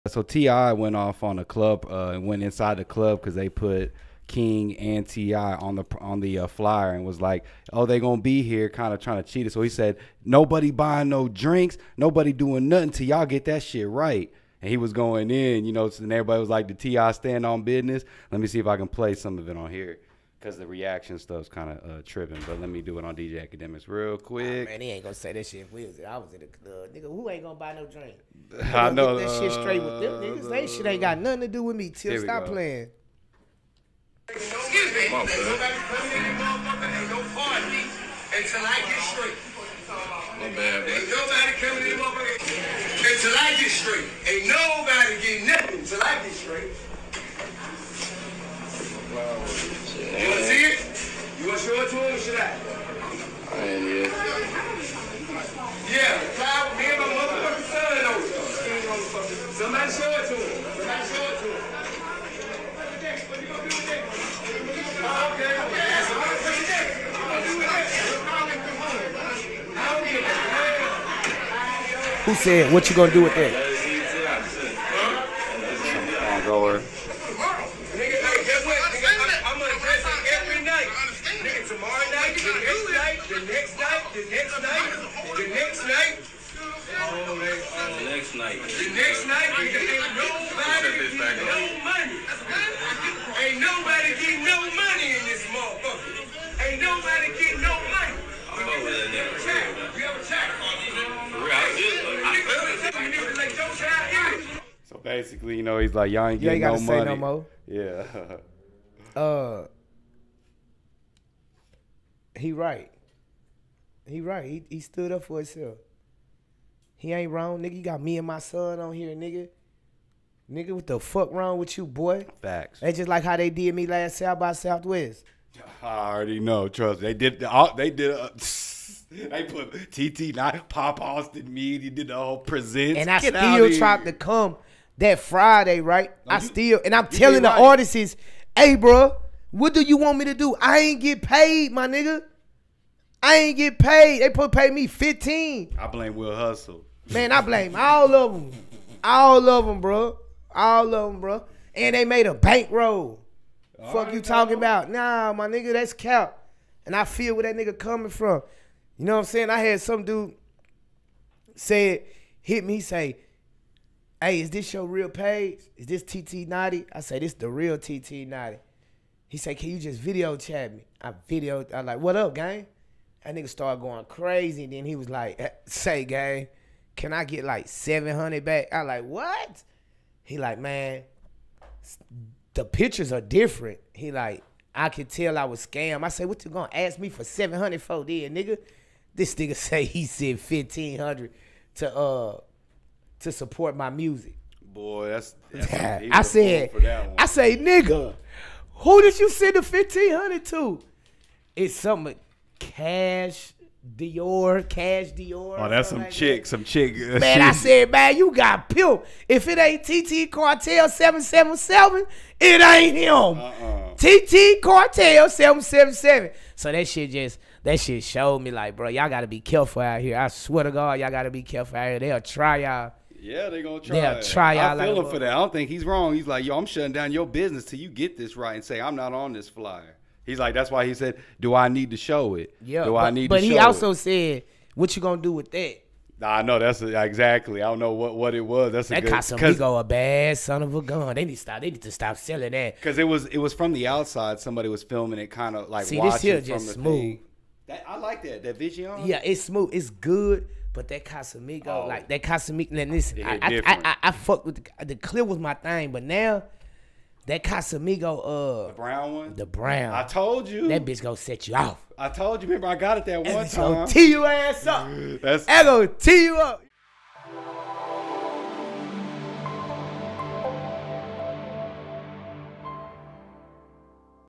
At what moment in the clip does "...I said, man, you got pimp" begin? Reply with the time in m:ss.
3:27.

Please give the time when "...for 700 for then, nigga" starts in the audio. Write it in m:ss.
3:07.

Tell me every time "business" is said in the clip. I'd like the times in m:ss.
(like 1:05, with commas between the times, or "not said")
0:17, 3:47.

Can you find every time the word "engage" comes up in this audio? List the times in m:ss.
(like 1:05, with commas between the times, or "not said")
not said.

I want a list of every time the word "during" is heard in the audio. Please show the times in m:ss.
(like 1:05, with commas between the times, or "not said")
not said.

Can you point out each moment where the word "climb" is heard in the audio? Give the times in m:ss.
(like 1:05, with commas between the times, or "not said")
not said.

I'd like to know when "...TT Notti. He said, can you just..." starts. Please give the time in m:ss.
2:47.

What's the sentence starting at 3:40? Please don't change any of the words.
I swear to God, y'all got to be careful out here.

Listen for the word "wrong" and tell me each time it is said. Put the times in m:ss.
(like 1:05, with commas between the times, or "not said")
1:57, 2:01, 3:45.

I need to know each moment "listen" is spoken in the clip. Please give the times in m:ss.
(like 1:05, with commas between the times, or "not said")
4:12.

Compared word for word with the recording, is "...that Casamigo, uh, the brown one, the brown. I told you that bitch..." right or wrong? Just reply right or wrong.
right.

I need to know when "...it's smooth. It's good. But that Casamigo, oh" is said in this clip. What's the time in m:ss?
4:09.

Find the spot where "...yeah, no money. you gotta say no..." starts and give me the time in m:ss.
1:46.